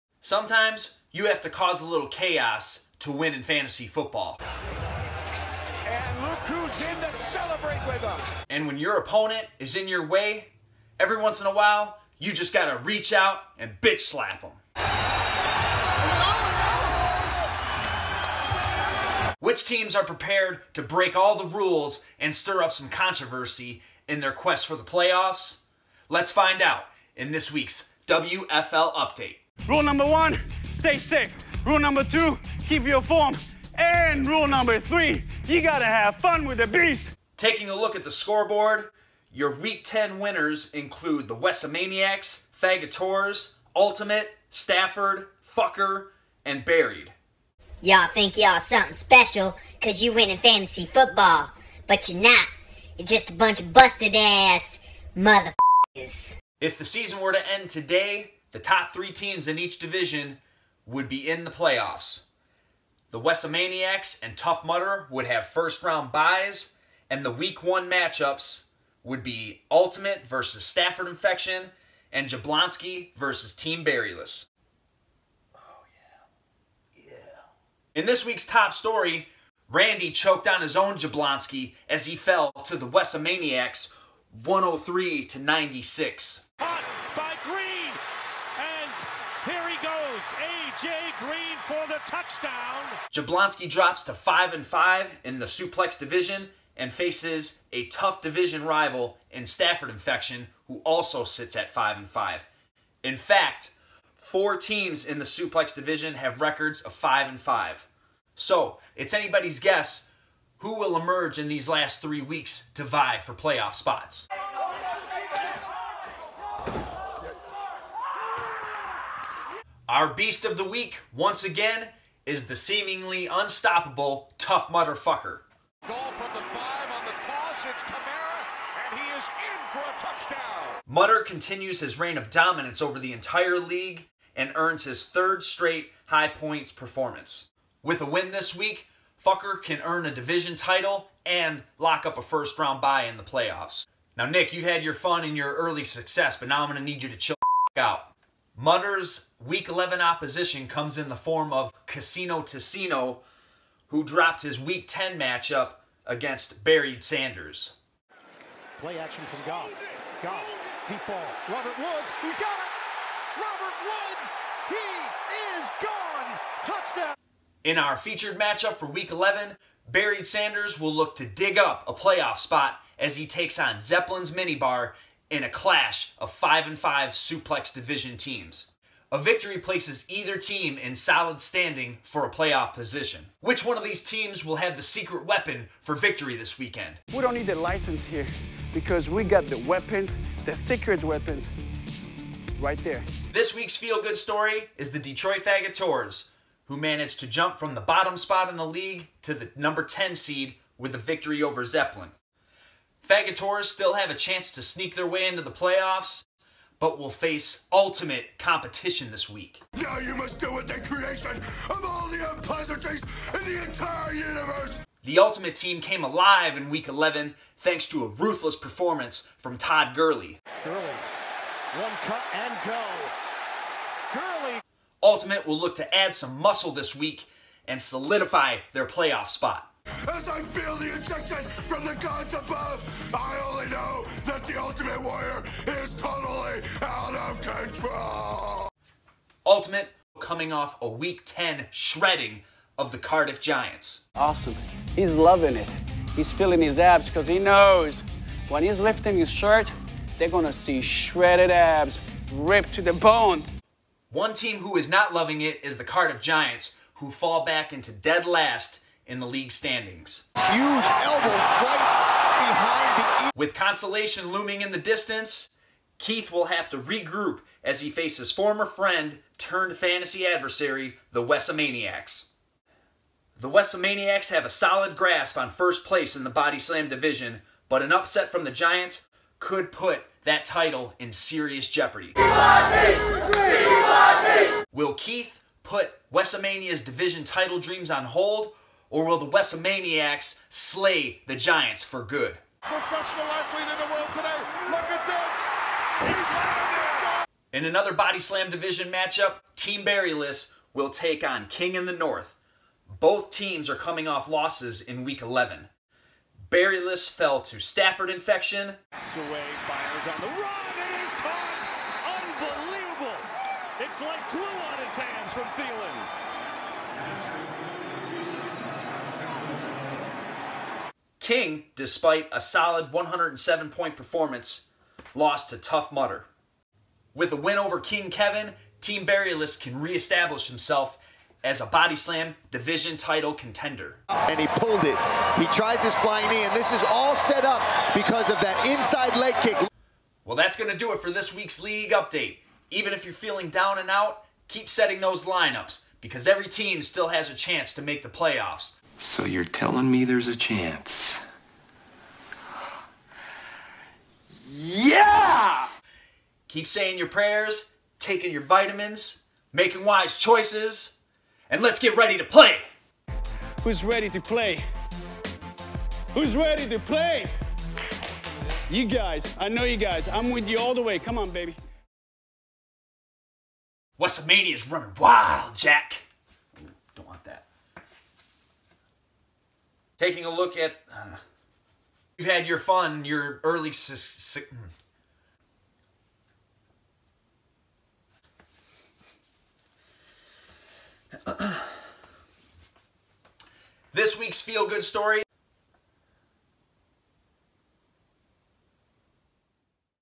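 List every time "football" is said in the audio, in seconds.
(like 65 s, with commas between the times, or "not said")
3 s, 50 s.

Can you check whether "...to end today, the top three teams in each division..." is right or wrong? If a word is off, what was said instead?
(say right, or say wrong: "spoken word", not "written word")
right.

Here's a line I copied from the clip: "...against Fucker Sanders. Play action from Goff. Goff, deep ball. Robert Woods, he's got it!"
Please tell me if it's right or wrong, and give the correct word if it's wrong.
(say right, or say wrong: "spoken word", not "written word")
wrong: "Buried", not "Fucker".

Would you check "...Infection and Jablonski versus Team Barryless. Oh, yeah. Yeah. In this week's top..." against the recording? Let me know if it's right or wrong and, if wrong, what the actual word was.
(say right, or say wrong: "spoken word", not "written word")
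right.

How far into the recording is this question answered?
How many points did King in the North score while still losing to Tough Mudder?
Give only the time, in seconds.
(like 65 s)
322 s.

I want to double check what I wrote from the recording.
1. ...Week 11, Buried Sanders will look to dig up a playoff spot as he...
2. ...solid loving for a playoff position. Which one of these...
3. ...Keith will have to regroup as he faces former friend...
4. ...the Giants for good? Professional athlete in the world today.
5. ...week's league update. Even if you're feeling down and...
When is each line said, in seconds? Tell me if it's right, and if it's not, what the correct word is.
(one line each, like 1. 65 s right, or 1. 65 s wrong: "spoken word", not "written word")
1. 168 s right
2. 180 s wrong: "standing", not "loving"
3. 265 s right
4. 291 s right
5. 341 s right.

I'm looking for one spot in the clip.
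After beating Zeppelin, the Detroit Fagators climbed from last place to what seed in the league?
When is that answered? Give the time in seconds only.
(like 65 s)
199 s.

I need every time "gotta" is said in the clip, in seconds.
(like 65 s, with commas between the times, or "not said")
12 s, 35 s.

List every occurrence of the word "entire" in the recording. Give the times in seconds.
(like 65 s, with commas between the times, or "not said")
133 s, 213 s.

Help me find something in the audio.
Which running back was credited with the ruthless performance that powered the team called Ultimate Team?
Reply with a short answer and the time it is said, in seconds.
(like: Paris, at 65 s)
Todd Gurley, at 219 s.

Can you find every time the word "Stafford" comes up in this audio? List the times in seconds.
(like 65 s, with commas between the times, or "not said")
44 s, 70 s, 99 s, 307 s.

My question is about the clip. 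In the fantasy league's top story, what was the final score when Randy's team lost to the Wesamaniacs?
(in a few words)
103 to 96.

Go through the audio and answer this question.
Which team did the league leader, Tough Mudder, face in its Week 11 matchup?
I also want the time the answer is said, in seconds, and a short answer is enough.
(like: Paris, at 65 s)
Casino Teceno, at 151 s.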